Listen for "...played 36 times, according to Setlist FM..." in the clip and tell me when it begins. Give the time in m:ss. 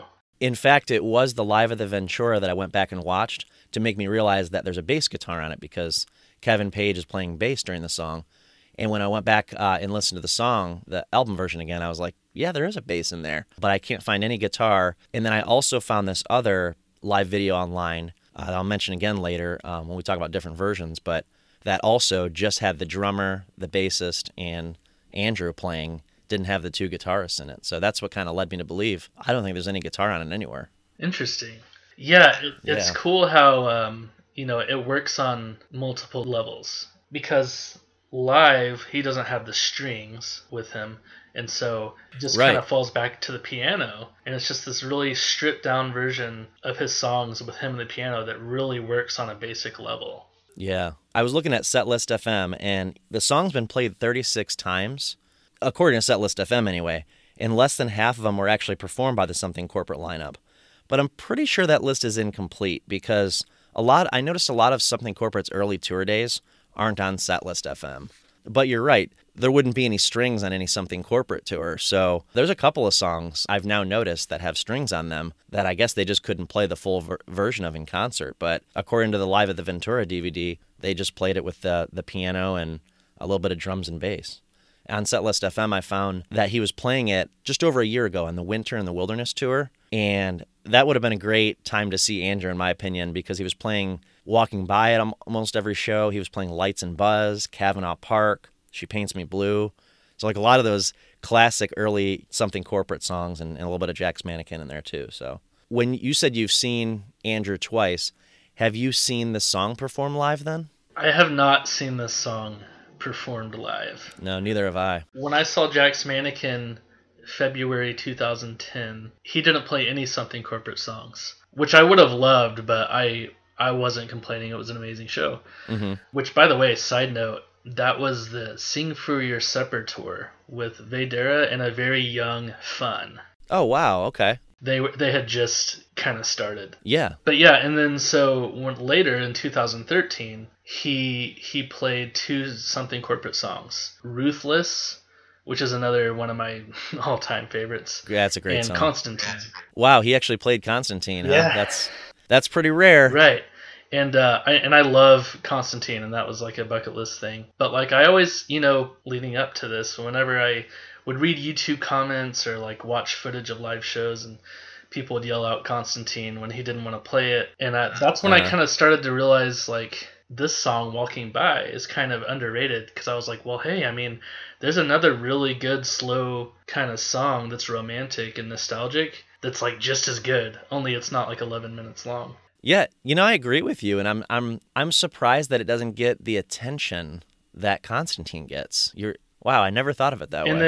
0:53.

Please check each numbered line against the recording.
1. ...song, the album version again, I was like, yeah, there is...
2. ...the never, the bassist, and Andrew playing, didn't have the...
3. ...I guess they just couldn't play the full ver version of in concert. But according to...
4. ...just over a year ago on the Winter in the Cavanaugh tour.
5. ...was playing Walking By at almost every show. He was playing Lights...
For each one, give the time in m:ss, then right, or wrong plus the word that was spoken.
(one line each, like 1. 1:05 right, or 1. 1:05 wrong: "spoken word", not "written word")
1. 0:10 right
2. 0:22 wrong: "drummer", not "never"
3. 1:15 right
4. 1:27 wrong: "Wilderness", not "Cavanaugh"
5. 1:33 right.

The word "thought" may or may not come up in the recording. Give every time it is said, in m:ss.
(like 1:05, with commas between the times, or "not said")
3:09.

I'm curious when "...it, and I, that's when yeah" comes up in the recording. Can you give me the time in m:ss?
2:47.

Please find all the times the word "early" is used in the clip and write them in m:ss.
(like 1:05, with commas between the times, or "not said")
1:05, 1:41.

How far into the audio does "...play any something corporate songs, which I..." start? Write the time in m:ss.
1:59.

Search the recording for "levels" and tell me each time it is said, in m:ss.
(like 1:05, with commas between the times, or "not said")
0:36, 0:49.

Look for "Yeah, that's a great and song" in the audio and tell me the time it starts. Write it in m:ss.
2:28.